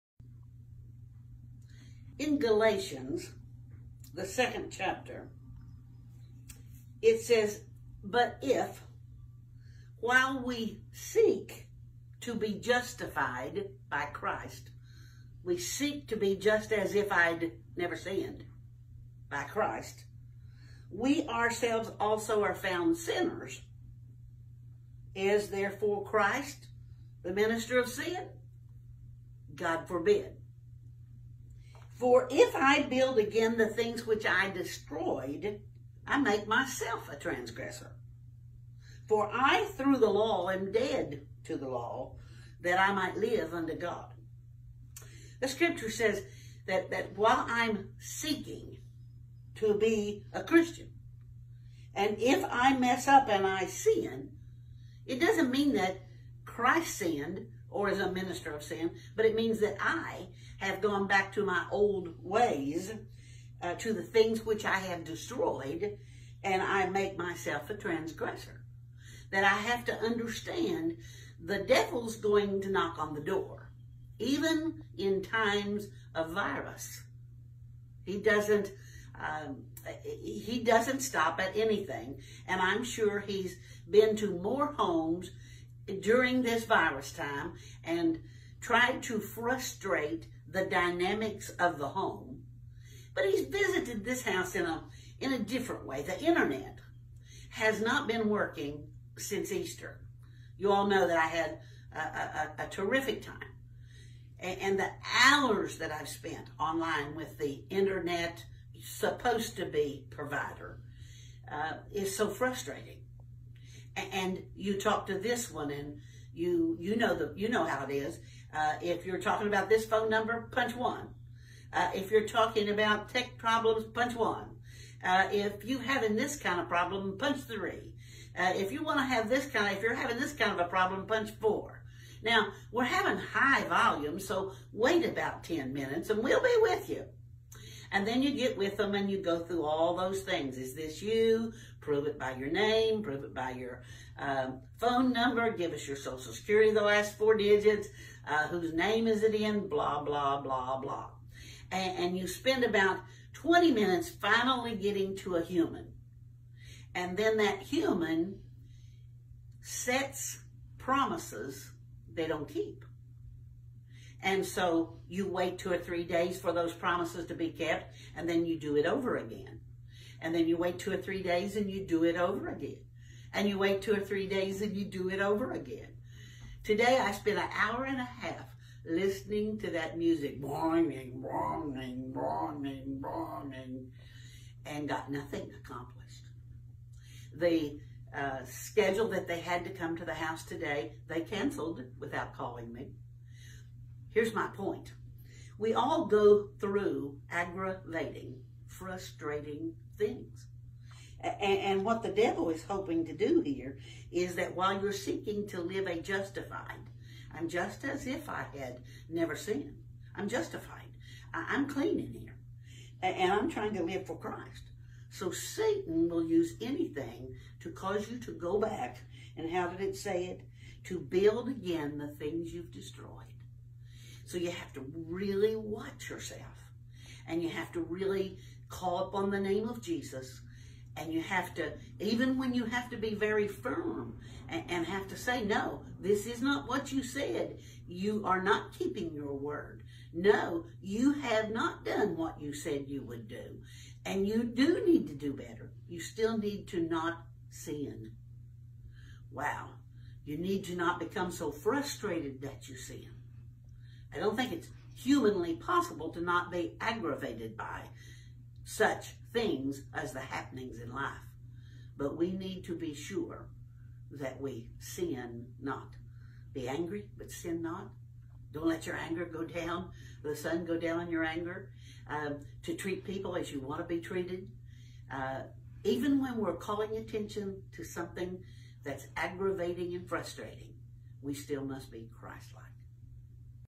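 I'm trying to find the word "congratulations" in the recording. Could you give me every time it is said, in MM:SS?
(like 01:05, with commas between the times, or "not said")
not said.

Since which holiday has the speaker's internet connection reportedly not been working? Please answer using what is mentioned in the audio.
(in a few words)
Easter.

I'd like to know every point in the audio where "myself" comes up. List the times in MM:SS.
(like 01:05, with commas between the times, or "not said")
00:36, 01:07.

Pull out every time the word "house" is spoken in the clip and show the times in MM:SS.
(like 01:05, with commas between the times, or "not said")
01:34, 03:10.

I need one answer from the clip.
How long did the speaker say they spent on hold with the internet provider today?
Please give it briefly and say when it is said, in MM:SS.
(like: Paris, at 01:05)
An hour and a half, at 02:57.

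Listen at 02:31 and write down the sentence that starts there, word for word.
And, and you spend about 20 minutes finally getting to a human.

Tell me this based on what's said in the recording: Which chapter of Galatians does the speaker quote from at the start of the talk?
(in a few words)
2.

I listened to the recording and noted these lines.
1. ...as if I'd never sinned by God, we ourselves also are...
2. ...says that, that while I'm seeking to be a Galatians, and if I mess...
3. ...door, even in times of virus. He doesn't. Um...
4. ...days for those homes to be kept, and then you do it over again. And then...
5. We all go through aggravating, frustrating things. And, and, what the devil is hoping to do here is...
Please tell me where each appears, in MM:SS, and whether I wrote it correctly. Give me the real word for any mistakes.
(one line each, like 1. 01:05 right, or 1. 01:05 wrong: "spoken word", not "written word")
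1. 00:16 wrong: "Christ", not "God"
2. 00:45 wrong: "Christian", not "Galatians"
3. 01:13 right
4. 02:46 wrong: "promises", not "homes"
5. 03:15 right.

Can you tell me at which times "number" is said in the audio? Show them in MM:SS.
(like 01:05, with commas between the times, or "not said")
02:00, 02:25.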